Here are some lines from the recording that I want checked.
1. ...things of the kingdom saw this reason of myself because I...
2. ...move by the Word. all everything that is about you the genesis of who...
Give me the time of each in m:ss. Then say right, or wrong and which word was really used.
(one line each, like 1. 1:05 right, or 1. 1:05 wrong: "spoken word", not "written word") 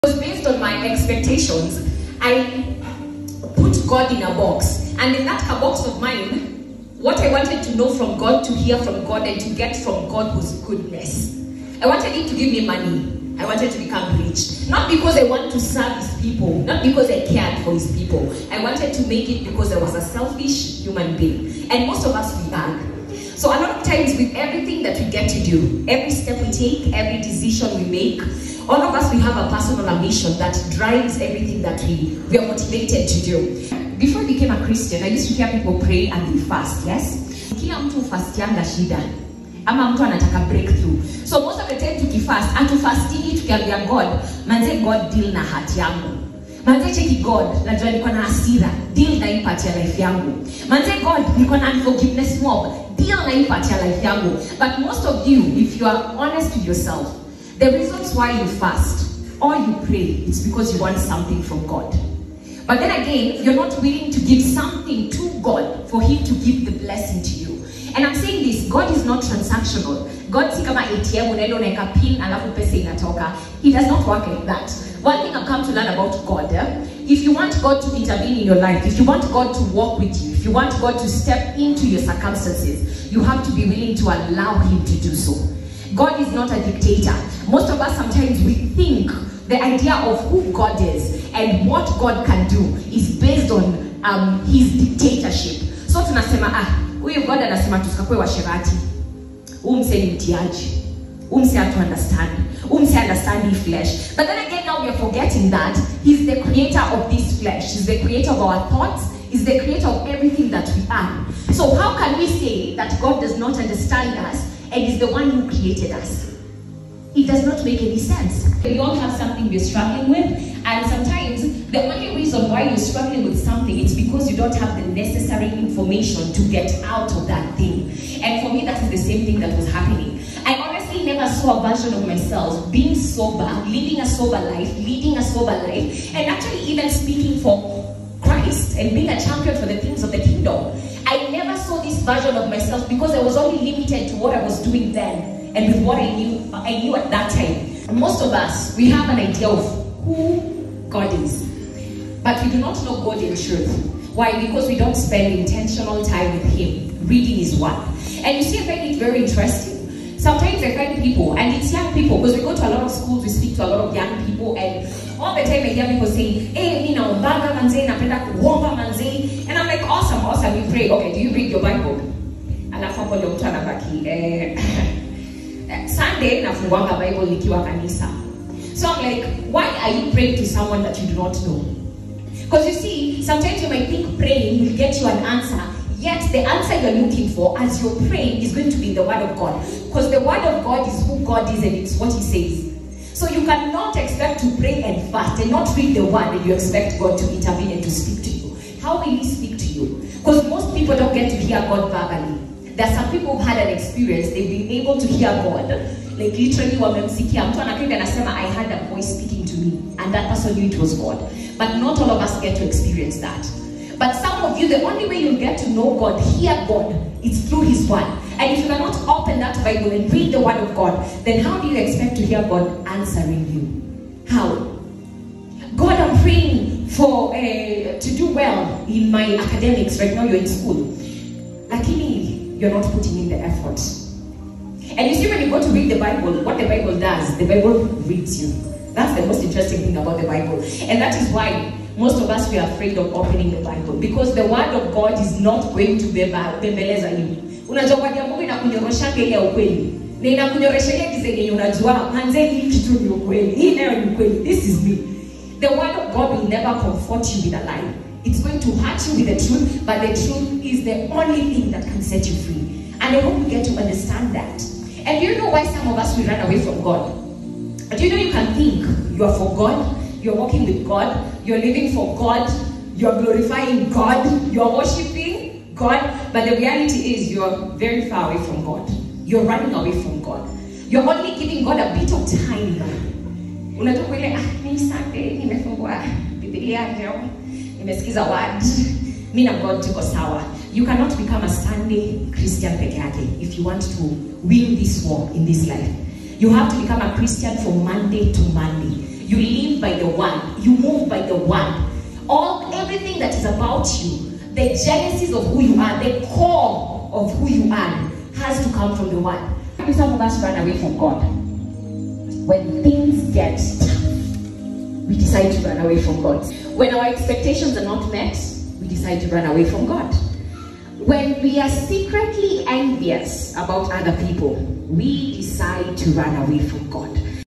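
1. 2:19 wrong: "version", not "reason"
2. 5:00 wrong: "One", not "Word".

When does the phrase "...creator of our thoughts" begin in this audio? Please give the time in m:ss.
1:47.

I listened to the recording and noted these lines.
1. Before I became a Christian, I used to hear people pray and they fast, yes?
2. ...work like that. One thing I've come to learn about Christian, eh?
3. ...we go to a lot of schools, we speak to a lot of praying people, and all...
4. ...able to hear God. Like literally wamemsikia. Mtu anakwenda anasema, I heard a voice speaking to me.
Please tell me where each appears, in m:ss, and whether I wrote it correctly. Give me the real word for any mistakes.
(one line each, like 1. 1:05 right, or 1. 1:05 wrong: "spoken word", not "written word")
1. 0:33 right
2. 1:14 wrong: "God", not "Christian"
3. 2:42 wrong: "young", not "praying"
4. 3:24 right.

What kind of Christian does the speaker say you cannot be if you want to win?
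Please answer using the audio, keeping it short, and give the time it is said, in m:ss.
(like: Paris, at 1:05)
Sunday Christian, at 4:51.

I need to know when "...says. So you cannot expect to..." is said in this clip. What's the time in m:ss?
3:12.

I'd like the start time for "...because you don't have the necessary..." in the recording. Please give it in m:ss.
2:03.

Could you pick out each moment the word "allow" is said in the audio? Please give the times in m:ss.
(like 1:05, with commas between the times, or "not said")
1:24.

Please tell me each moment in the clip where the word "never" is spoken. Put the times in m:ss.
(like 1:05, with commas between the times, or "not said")
2:11, 4:16.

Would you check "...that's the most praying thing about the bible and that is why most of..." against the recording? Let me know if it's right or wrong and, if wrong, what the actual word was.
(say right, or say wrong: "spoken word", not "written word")
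wrong: "interesting", not "praying".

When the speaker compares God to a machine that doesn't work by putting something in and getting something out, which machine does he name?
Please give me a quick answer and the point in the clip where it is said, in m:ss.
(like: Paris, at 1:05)
ATM, at 1:10.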